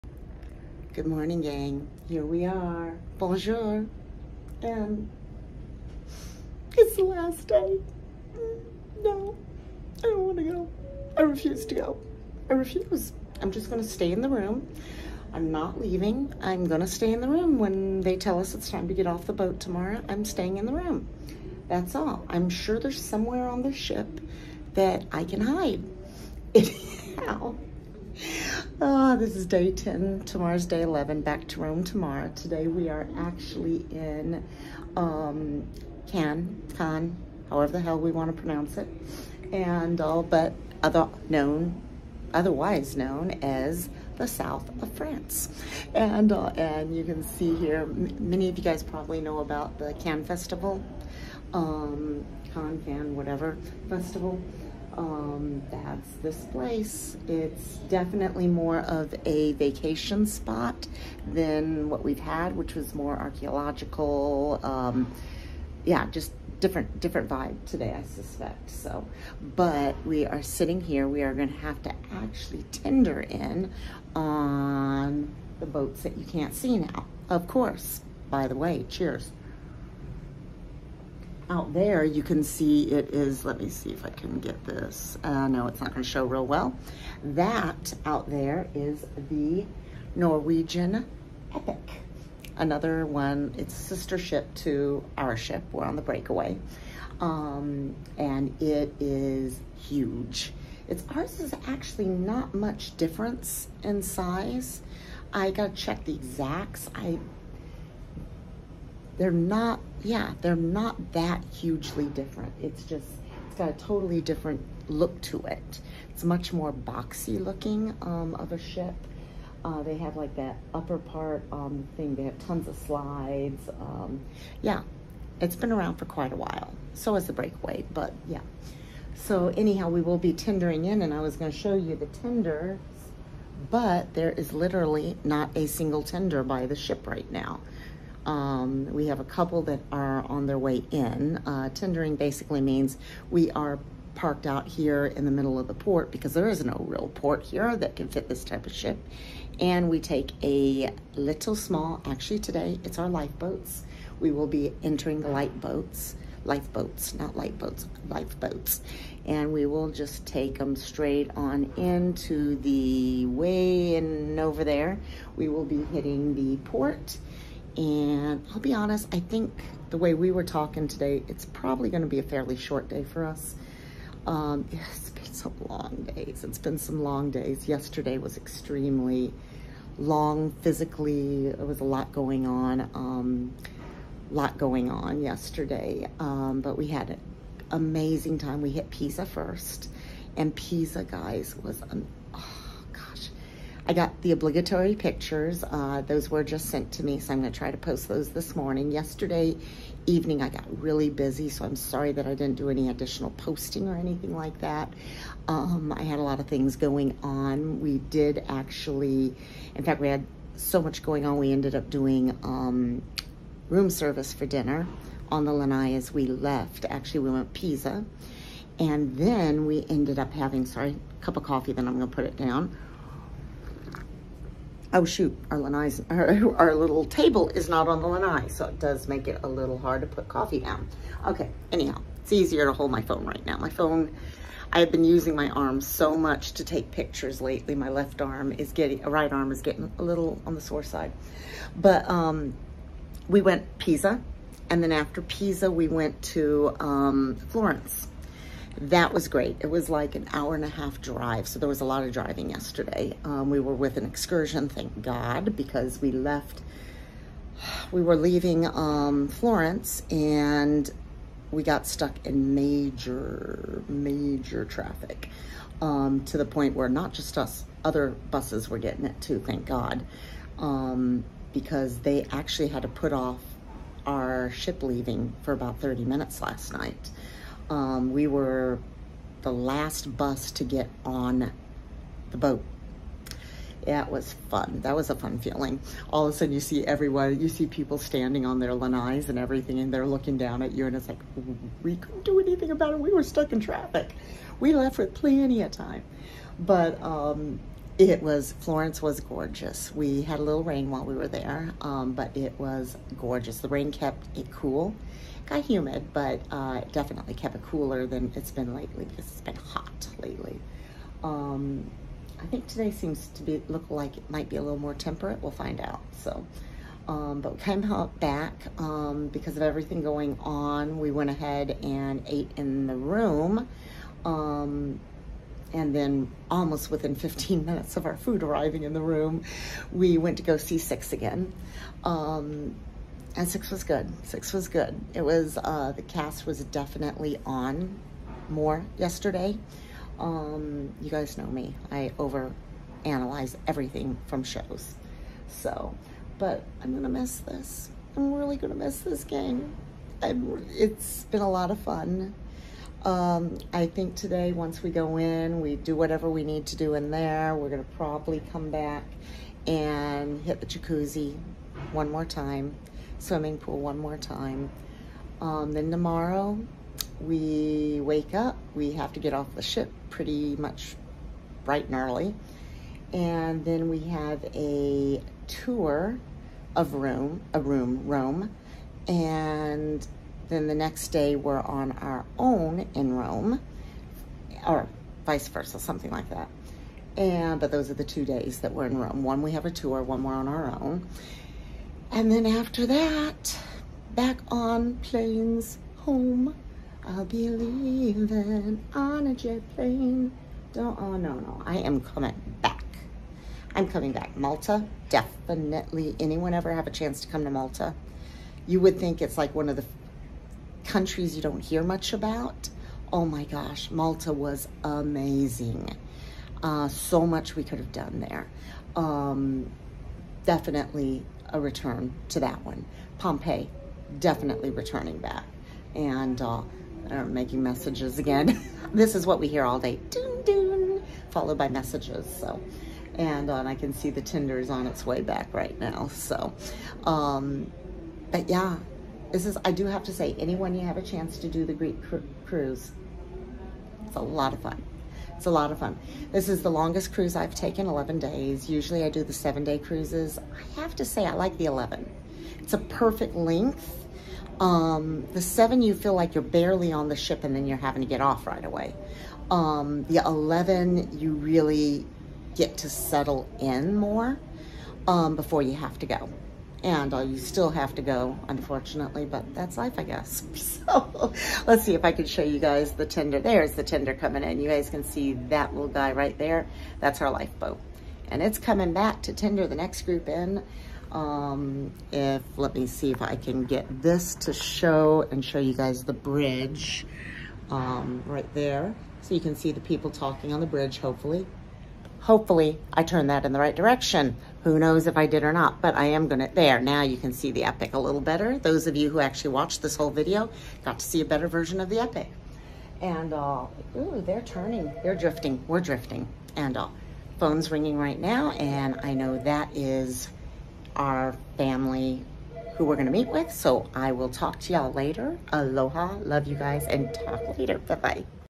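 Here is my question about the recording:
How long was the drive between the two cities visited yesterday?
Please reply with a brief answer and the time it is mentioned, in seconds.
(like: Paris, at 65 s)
An hour and a half, at 250 s.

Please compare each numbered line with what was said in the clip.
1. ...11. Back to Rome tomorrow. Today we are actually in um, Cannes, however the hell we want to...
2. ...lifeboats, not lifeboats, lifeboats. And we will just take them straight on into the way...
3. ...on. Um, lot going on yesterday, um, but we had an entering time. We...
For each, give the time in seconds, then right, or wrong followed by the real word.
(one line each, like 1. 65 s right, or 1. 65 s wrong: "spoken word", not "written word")
1. 30 s right
2. 156 s right
3. 182 s wrong: "amazing", not "entering".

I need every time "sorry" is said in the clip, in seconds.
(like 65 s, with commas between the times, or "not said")
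201 s, 220 s.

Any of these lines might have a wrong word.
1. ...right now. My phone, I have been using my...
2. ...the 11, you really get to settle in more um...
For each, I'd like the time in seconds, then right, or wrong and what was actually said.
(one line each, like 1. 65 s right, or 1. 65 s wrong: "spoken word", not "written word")
1. 233 s right
2. 460 s right.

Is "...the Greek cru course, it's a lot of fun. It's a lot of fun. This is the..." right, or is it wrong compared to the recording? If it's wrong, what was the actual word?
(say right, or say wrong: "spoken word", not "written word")
wrong: "cruise", not "course".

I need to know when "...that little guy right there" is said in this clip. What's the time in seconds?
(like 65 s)
475 s.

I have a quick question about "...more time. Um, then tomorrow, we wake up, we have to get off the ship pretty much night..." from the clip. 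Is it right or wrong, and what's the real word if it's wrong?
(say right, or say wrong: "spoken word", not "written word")
wrong: "bright", not "night".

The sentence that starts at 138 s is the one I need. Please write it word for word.
Um, we have a couple that are on their way in.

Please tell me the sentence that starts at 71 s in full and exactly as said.
We are going to have to actually tender in on the boats that you can't see now.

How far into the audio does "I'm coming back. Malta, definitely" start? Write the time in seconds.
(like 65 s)
403 s.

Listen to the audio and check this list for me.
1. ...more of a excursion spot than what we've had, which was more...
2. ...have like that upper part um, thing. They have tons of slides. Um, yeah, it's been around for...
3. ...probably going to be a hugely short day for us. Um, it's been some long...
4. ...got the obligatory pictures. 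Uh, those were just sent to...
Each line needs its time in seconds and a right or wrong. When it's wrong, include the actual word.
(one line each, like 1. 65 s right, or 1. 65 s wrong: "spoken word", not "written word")
1. 58 s wrong: "vacation", not "excursion"
2. 119 s right
3. 171 s wrong: "fairly", not "hugely"
4. 193 s right.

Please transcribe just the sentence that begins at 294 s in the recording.
We left with plenty of time.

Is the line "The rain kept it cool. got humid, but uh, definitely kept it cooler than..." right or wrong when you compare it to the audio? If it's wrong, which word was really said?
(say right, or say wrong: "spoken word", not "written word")
right.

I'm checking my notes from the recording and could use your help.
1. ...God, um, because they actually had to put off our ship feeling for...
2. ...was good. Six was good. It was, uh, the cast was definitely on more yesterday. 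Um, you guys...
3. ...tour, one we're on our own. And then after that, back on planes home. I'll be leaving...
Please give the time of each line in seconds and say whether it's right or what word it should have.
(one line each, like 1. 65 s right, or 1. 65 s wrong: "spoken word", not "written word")
1. 269 s wrong: "leaving", not "feeling"
2. 333 s right
3. 389 s right.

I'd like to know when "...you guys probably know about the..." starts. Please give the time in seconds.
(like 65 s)
48 s.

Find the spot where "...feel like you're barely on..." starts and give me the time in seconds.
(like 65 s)
455 s.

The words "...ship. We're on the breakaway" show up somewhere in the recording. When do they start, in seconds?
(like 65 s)
95 s.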